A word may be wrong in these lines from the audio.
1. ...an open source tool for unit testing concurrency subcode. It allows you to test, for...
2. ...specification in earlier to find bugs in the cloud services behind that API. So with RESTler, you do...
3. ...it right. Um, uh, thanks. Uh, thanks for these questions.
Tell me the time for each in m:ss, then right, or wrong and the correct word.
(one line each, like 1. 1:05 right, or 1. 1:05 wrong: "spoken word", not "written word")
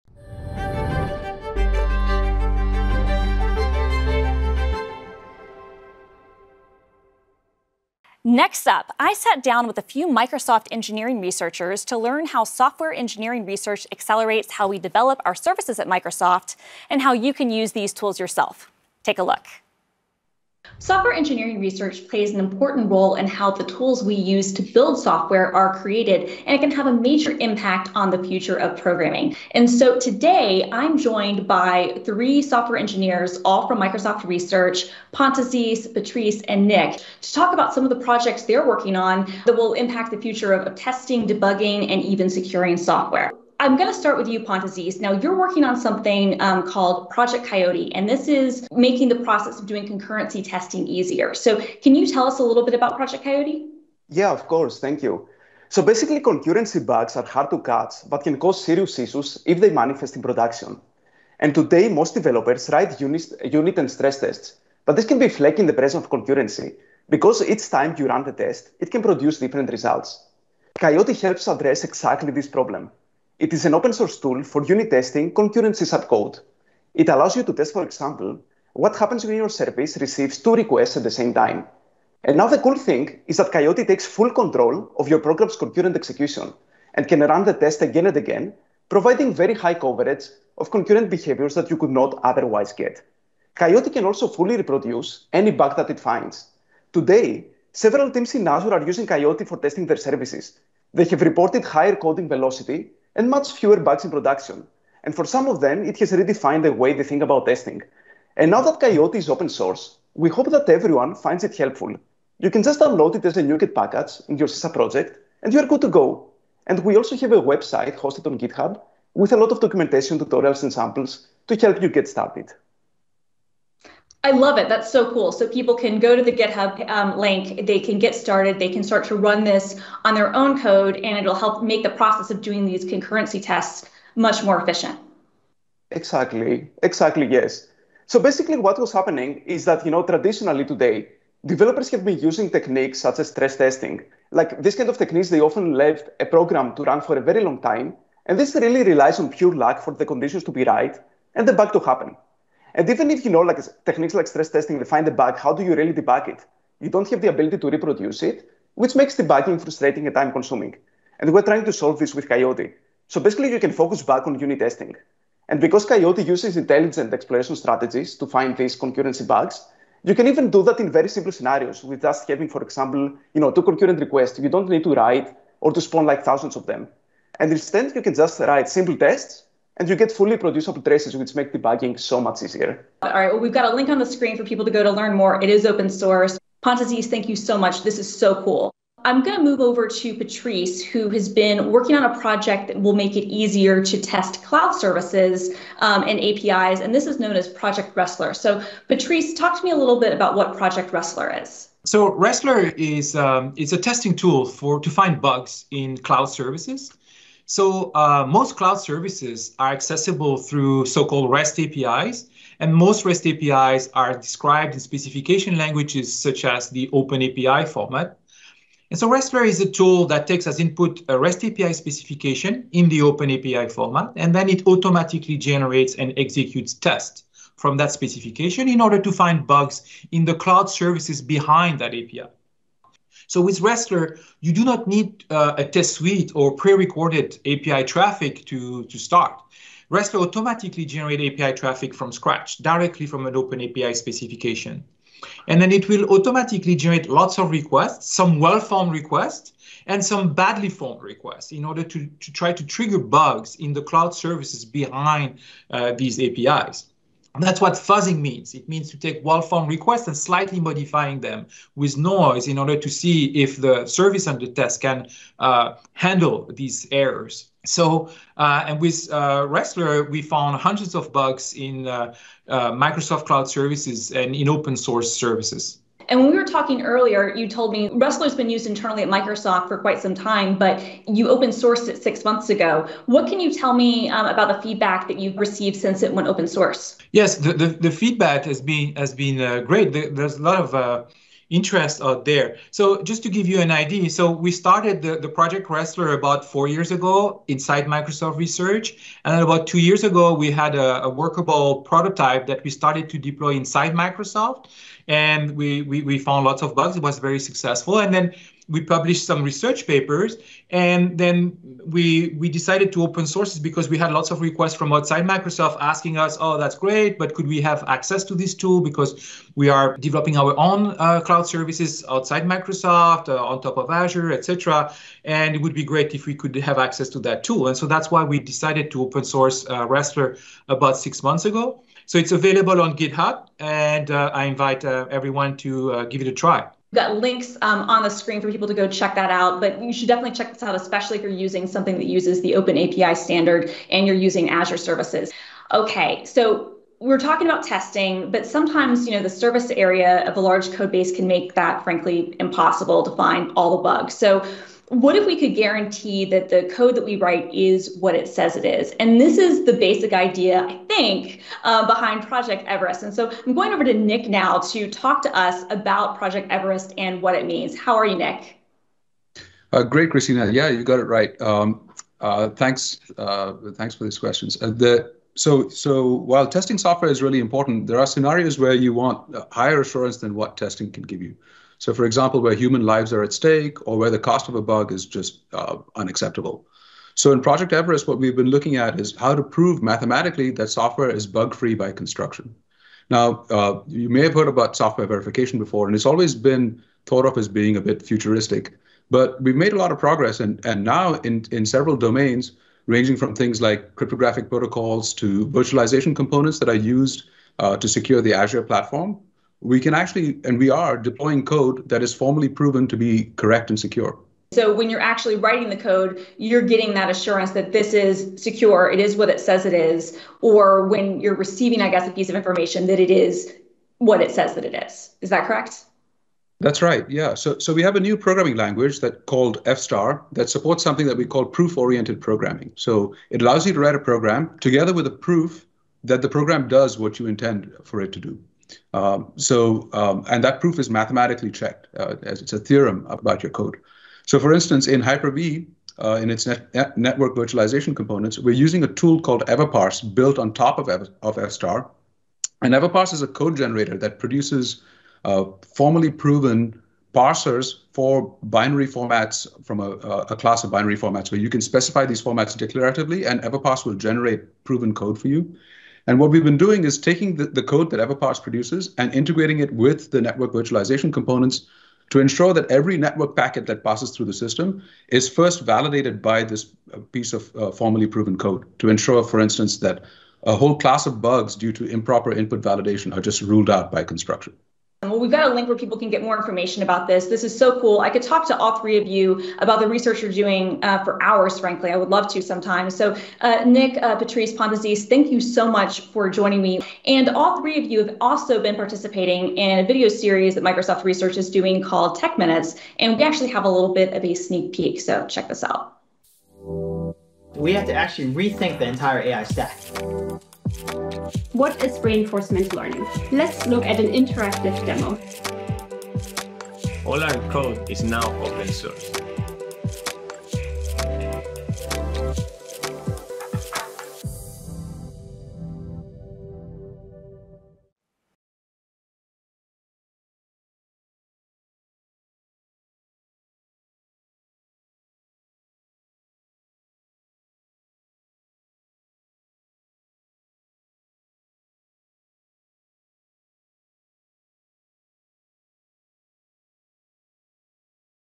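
1. 1:13 right
2. 3:47 wrong: "order", not "earlier"
3. 6:10 right.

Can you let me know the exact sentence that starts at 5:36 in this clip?
We've got links um, on the screen for people to go check that out.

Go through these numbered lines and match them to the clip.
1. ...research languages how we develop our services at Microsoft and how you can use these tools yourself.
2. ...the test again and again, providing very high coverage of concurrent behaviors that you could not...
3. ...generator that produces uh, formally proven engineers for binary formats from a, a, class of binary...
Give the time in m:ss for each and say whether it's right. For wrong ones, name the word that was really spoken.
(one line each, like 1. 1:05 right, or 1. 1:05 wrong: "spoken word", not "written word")
1. 0:13 wrong: "accelerates", not "languages"
2. 1:27 right
3. 7:33 wrong: "parsers", not "engineers".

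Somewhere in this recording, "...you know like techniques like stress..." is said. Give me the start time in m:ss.
2:33.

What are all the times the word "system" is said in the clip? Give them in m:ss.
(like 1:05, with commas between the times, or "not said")
7:54.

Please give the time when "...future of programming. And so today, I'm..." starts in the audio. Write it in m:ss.
0:28.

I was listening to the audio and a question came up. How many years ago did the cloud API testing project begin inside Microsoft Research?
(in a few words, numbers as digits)
4.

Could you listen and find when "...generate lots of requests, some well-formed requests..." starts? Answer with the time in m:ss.
4:06.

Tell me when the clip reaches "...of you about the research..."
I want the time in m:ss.
8:08.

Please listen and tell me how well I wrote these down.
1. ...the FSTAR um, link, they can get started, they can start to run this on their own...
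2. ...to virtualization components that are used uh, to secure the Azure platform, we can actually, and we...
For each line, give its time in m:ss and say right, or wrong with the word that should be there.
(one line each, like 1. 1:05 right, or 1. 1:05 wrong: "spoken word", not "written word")
1. 2:06 wrong: "GitHub", not "FSTAR"
2. 6:45 right.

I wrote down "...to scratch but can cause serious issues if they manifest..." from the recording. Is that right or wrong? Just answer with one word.
wrong.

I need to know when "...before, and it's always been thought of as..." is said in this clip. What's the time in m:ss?
6:35.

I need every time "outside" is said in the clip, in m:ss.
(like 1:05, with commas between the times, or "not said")
5:14, 5:22.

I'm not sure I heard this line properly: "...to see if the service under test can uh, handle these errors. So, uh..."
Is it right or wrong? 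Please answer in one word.
right.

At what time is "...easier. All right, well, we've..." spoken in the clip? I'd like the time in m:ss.
3:02.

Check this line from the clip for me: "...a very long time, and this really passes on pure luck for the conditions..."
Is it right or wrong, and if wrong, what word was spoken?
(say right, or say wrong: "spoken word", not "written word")
wrong: "relies", not "passes".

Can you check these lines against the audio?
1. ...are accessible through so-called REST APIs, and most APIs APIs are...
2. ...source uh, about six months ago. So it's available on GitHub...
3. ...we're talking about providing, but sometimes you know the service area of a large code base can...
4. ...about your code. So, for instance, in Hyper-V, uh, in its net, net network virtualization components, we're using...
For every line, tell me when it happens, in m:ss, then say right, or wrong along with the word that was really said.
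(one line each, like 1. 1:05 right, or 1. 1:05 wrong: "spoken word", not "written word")
1. 3:29 wrong: "REST", not "APIs"
2. 5:29 right
3. 5:46 wrong: "testing", not "providing"
4. 7:23 right.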